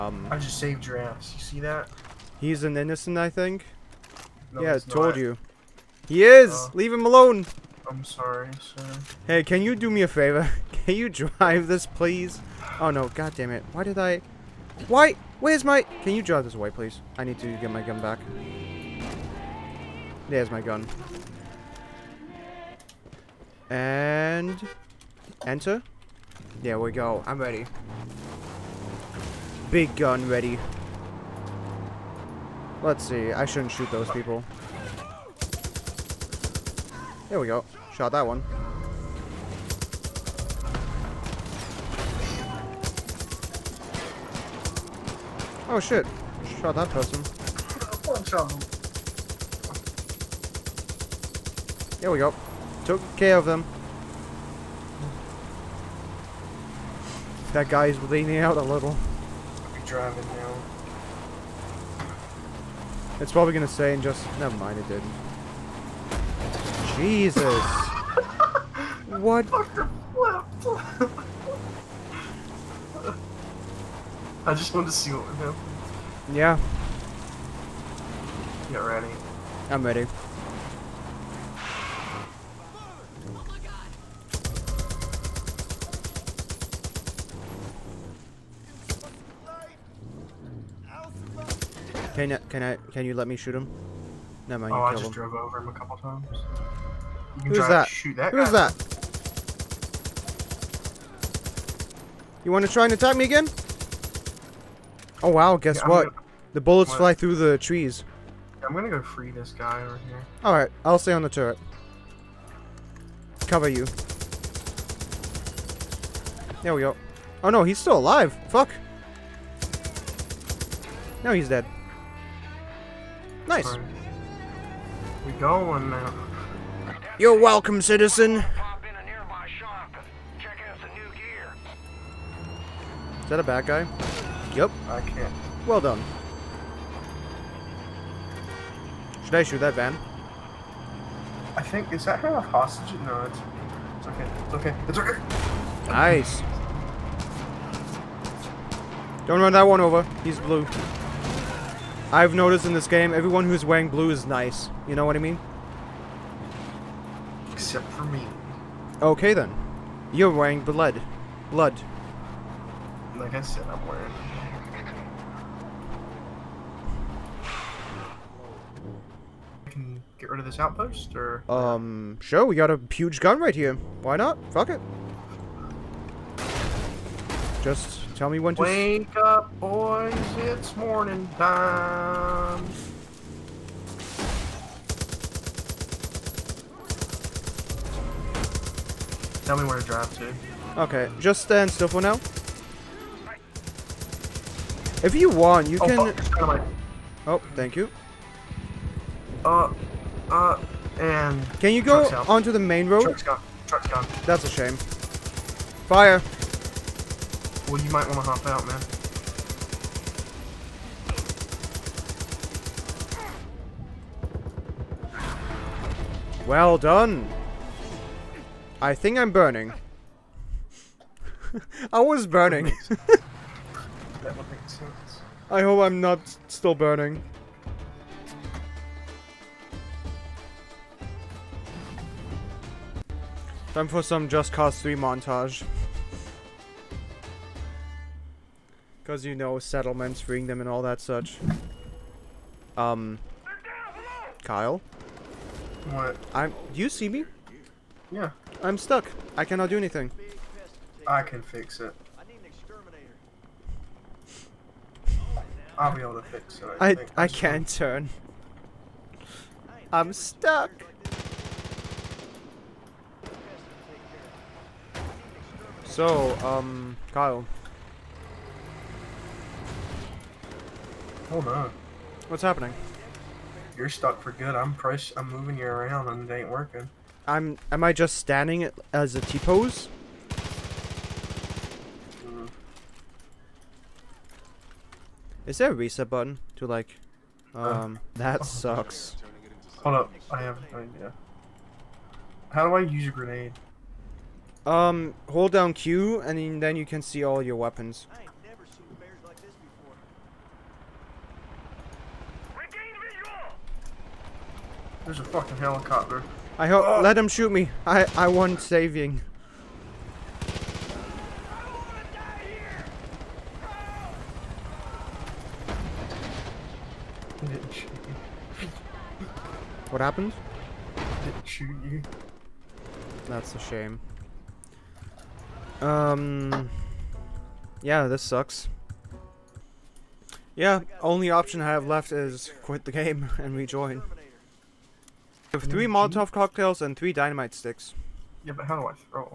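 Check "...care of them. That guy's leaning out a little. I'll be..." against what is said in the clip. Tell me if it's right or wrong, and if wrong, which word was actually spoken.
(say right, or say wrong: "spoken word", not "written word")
right.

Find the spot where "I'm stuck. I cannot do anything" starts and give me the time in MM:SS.
04:08.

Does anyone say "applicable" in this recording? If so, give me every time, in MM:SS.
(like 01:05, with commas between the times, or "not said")
not said.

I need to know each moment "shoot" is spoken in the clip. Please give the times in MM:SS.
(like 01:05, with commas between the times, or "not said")
00:33, 01:33, 02:19, 05:07, 05:21.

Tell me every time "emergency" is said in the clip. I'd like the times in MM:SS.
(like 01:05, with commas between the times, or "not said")
not said.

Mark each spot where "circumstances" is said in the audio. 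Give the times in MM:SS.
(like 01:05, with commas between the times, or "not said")
not said.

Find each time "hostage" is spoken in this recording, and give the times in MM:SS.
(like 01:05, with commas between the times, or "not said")
02:22.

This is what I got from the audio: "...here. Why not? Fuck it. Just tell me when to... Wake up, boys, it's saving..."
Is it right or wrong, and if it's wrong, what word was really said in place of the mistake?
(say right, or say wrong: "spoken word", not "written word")
wrong: "morning", not "saving".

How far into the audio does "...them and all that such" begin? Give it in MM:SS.
04:00.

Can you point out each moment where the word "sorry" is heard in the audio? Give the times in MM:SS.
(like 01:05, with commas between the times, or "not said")
00:08.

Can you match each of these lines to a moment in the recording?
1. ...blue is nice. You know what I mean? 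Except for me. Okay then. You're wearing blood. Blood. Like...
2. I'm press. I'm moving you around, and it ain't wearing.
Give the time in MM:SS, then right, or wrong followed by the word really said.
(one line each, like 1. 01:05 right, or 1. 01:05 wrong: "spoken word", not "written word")
1. 02:33 right
2. 04:34 wrong: "working", not "wearing".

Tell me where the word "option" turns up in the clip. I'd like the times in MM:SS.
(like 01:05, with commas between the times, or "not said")
05:31.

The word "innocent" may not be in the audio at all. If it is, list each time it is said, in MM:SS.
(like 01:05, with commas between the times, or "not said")
00:02.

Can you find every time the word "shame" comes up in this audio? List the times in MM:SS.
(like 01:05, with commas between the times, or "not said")
03:24, 05:23.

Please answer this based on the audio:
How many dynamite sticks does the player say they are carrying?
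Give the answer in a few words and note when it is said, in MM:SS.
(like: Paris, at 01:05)
3, at 05:36.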